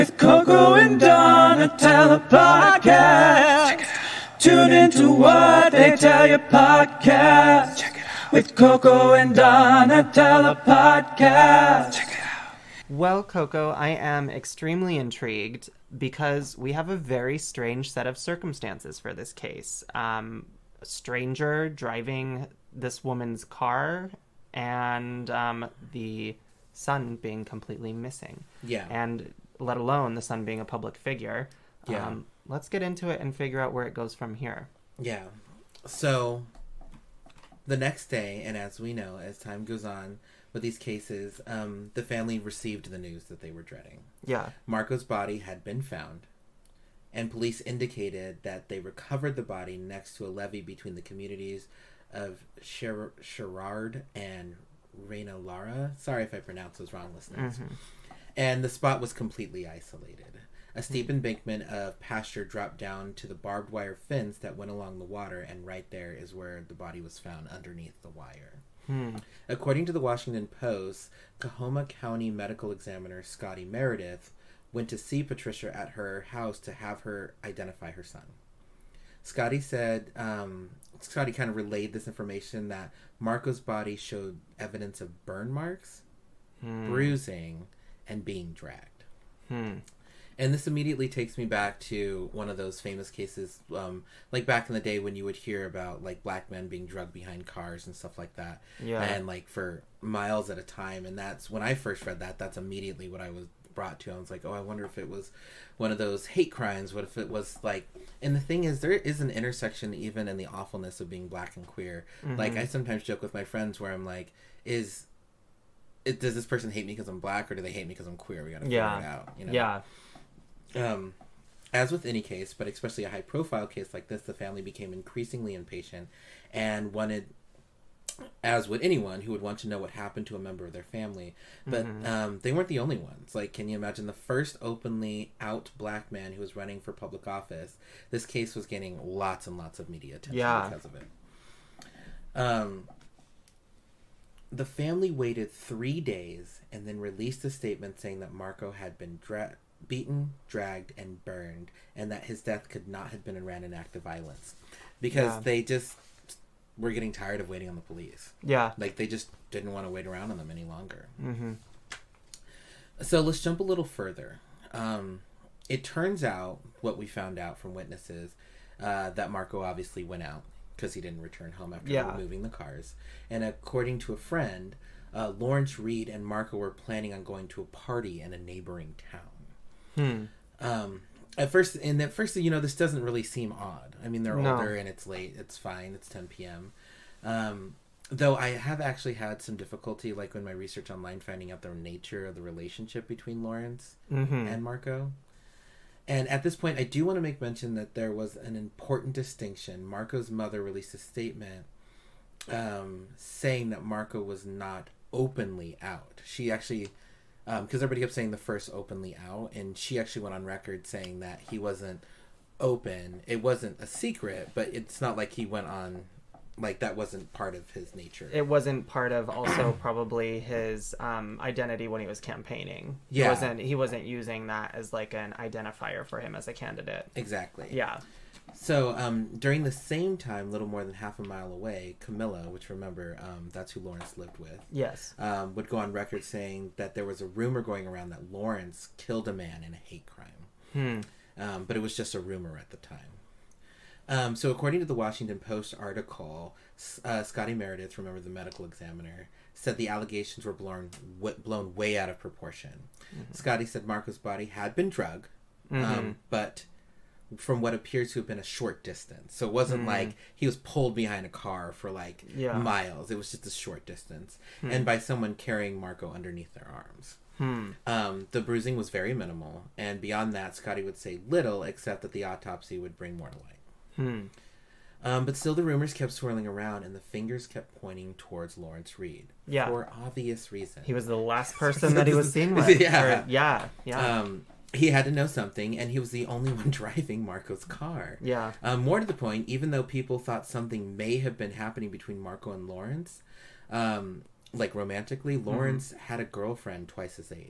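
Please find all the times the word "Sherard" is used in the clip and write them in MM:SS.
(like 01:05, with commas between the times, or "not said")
00:52.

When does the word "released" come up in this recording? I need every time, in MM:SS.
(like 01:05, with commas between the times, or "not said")
02:26, 03:20.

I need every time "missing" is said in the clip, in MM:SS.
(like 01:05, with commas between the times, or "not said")
00:27.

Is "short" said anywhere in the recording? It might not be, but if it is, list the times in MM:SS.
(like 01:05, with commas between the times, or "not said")
04:18, 04:23.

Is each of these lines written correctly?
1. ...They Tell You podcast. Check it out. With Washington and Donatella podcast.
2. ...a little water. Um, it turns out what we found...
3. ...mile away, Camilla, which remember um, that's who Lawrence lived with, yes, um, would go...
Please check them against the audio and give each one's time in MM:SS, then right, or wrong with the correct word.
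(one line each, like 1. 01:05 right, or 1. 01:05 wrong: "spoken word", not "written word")
1. 00:05 wrong: "Coco", not "Washington"
2. 02:43 wrong: "further", not "water"
3. 03:51 right.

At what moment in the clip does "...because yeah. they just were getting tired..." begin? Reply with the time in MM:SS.
02:34.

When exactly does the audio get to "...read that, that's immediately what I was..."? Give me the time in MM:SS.
01:42.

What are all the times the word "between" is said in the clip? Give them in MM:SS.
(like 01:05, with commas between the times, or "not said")
00:50, 03:13, 04:51.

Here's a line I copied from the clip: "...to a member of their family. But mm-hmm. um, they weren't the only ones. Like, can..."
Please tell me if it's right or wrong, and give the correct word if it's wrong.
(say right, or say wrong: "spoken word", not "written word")
right.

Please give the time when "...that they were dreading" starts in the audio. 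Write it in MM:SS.
00:43.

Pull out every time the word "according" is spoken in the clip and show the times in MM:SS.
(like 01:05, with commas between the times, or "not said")
01:09, 02:53, 04:04.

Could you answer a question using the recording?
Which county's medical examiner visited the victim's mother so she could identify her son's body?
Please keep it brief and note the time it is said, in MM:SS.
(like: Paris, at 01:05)
Coahoma County, at 01:11.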